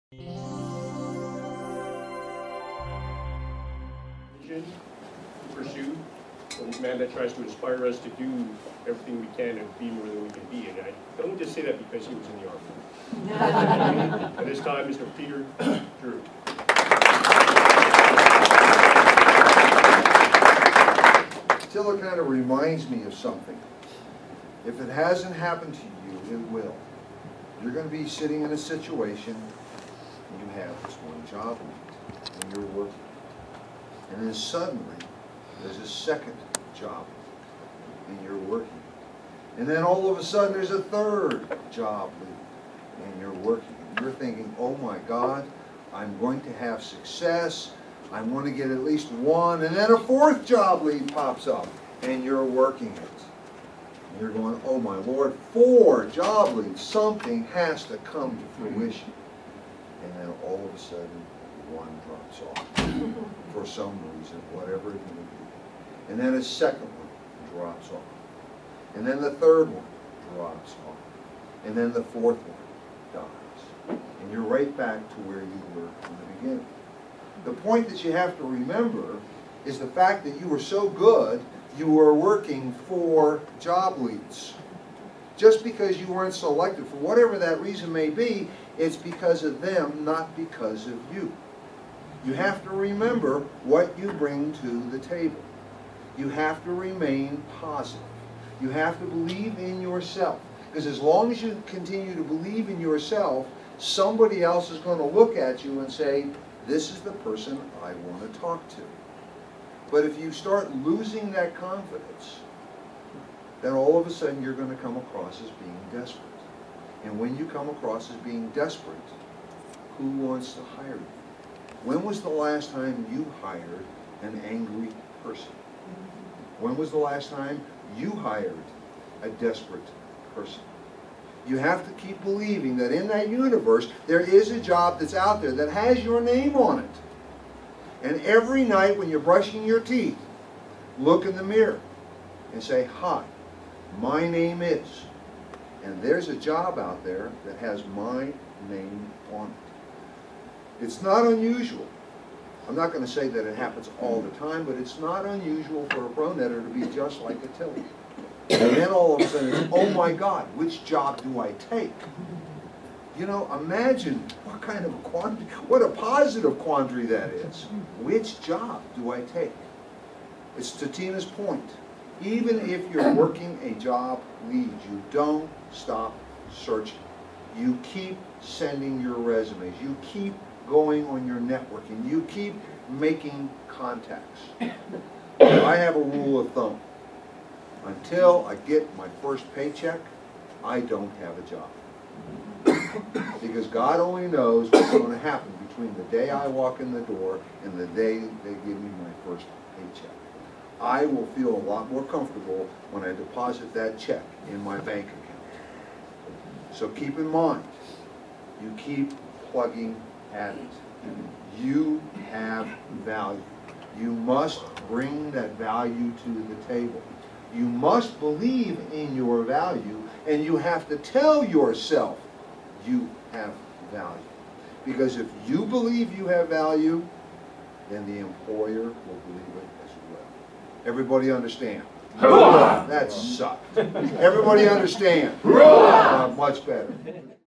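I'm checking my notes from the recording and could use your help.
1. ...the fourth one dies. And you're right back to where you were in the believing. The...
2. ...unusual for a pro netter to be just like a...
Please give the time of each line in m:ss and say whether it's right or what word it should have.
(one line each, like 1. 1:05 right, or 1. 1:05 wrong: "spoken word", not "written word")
1. 1:11 wrong: "beginning", not "believing"
2. 2:35 right.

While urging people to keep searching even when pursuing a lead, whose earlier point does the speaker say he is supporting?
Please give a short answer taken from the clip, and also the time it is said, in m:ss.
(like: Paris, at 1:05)
Tina, at 2:50.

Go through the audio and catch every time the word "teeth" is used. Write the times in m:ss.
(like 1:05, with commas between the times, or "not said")
2:19.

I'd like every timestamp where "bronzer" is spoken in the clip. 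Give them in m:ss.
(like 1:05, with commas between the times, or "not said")
not said.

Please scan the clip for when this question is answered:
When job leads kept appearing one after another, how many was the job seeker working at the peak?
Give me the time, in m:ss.
0:55.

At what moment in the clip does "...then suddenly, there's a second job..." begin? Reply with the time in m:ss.
0:34.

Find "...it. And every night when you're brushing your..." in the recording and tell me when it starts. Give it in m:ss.
2:16.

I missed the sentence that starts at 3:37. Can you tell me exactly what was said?
You must believe in your value, and you have to tell yourself you have value.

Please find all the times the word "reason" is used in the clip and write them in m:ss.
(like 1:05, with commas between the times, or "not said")
1:04, 1:27.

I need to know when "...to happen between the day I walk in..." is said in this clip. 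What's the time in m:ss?
3:15.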